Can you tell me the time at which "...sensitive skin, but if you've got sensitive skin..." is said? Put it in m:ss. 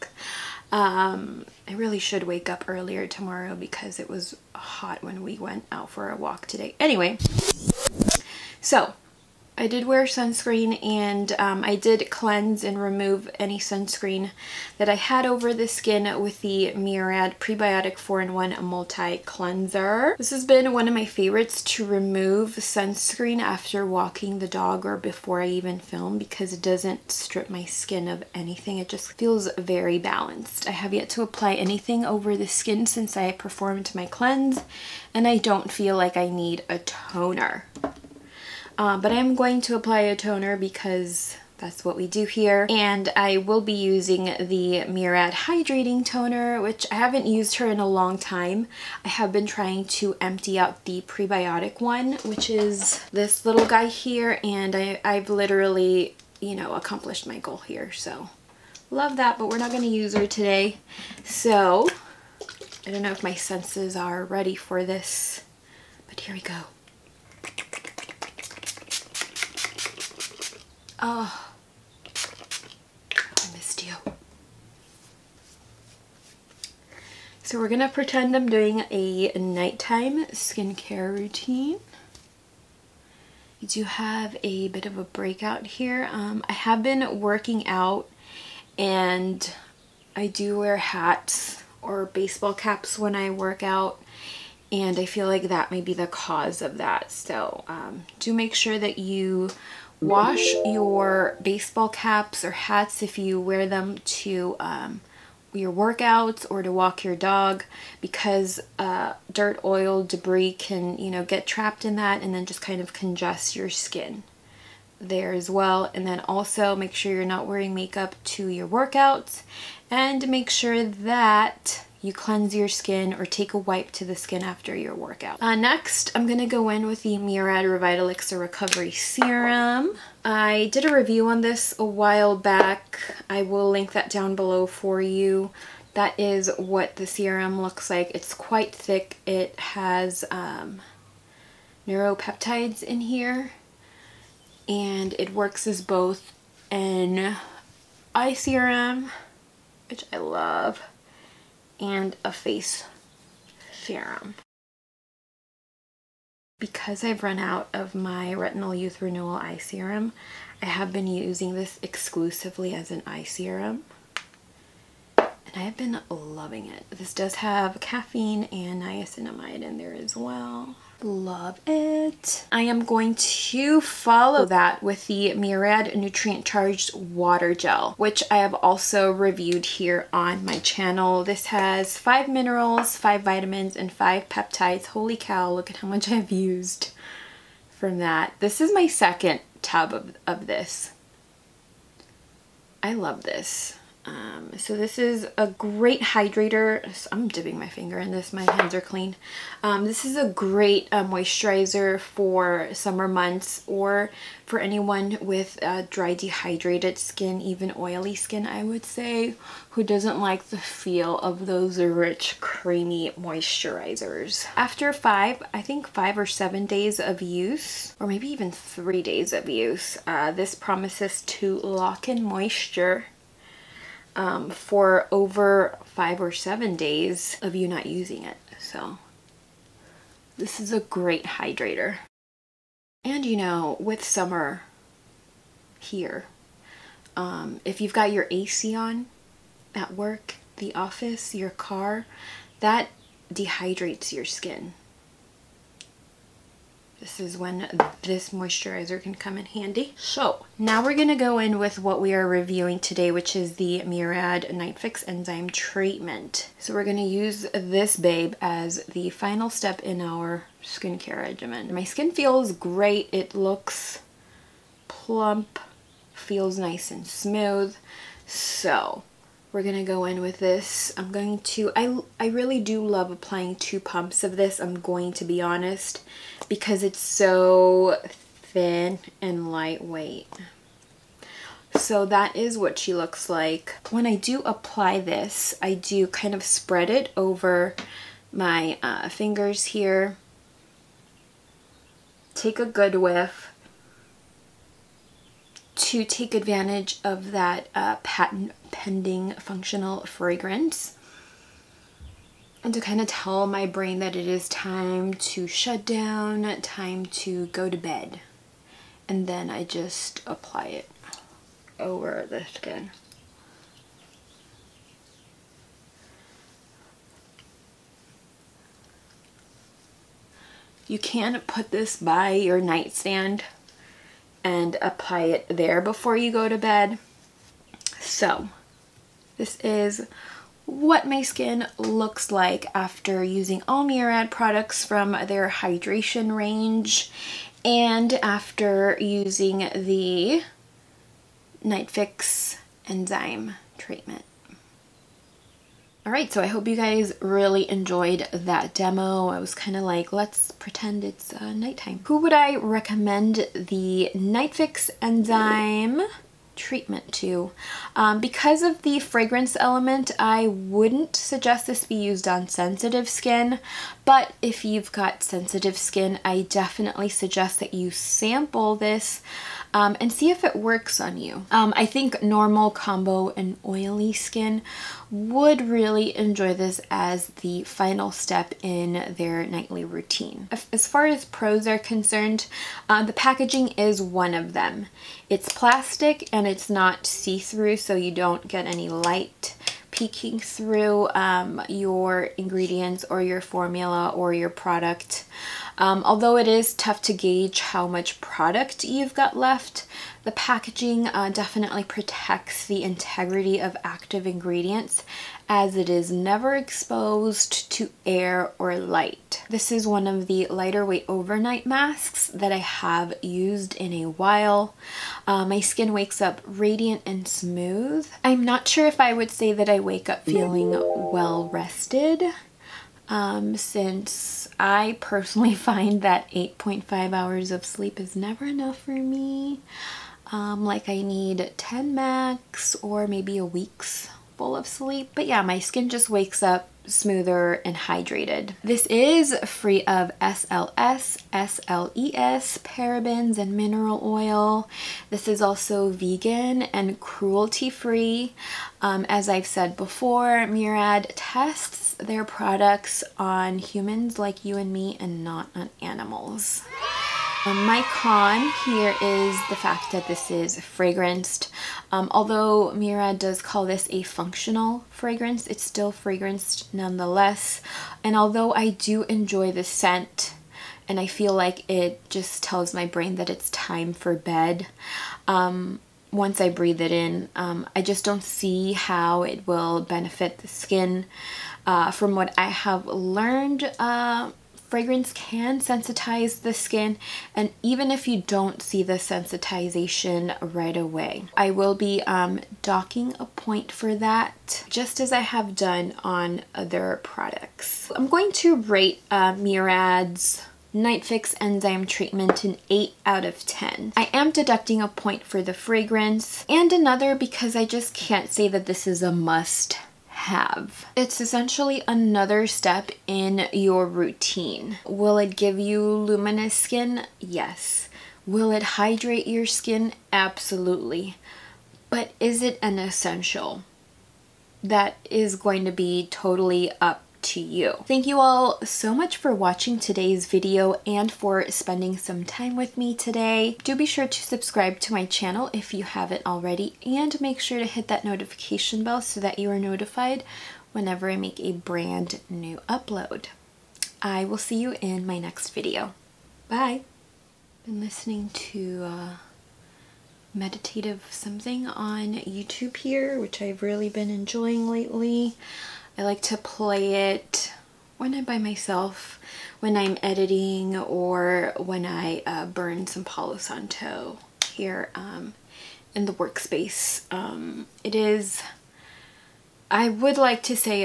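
6:02.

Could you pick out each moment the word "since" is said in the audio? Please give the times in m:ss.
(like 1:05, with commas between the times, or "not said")
0:32, 7:03.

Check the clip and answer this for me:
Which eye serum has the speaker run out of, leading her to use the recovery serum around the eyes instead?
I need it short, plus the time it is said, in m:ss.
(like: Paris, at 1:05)
Retinol Youth Renewal Eye Serum, at 2:38.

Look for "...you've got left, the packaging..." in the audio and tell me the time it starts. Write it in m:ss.
6:38.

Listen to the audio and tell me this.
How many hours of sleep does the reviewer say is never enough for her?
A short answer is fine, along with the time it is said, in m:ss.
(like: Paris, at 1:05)
8.5, at 7:06.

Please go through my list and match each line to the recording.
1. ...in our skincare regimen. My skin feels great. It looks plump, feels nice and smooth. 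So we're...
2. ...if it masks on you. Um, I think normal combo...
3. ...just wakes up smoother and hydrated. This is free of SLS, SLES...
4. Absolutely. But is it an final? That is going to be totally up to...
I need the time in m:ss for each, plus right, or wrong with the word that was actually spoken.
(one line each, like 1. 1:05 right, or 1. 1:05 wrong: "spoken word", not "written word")
1. 4:19 right
2. 6:10 wrong: "works", not "masks"
3. 7:15 right
4. 8:40 wrong: "essential", not "final".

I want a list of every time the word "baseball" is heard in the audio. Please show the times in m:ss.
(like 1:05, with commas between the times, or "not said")
1:32, 1:41.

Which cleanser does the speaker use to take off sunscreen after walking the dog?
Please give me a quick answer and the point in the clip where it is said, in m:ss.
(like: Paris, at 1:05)
Murad Prebiotic 4-in-1 Multi Cleanser, at 0:16.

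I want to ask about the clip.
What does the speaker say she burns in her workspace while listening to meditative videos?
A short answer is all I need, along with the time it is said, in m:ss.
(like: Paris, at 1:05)
Palo Santo, at 9:23.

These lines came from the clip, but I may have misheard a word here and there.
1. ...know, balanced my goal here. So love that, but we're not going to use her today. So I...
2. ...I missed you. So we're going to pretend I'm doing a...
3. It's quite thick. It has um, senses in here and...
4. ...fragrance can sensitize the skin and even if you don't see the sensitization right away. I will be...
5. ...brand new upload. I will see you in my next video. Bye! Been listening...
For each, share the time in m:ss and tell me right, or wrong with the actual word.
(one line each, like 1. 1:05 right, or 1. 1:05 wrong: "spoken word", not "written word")
1. 0:56 wrong: "accomplished", not "balanced"
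2. 1:12 right
3. 2:18 wrong: "neuropeptides", not "senses"
4. 8:04 right
5. 9:01 right.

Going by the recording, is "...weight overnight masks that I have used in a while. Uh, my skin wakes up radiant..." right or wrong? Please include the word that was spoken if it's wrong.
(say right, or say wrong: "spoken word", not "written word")
right.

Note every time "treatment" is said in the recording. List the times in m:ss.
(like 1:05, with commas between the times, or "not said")
4:15, 5:43, 5:56, 8:21.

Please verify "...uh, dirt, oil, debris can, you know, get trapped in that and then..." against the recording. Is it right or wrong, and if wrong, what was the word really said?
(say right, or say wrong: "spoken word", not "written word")
right.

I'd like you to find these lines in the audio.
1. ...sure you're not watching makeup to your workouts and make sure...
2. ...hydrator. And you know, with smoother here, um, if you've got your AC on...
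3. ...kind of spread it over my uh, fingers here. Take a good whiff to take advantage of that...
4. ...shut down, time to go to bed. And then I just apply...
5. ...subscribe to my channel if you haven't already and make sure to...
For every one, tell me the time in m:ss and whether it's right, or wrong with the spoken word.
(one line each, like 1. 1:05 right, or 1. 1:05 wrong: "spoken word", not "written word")
1. 1:56 wrong: "wearing", not "watching"
2. 3:51 wrong: "summer", not "smoother"
3. 4:46 right
4. 5:05 right
5. 8:54 right.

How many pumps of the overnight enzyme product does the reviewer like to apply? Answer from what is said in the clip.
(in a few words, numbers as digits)
2.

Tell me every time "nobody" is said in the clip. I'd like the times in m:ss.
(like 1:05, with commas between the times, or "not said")
not said.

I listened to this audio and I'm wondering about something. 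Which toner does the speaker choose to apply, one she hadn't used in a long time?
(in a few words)
Murad Hydrating Toner.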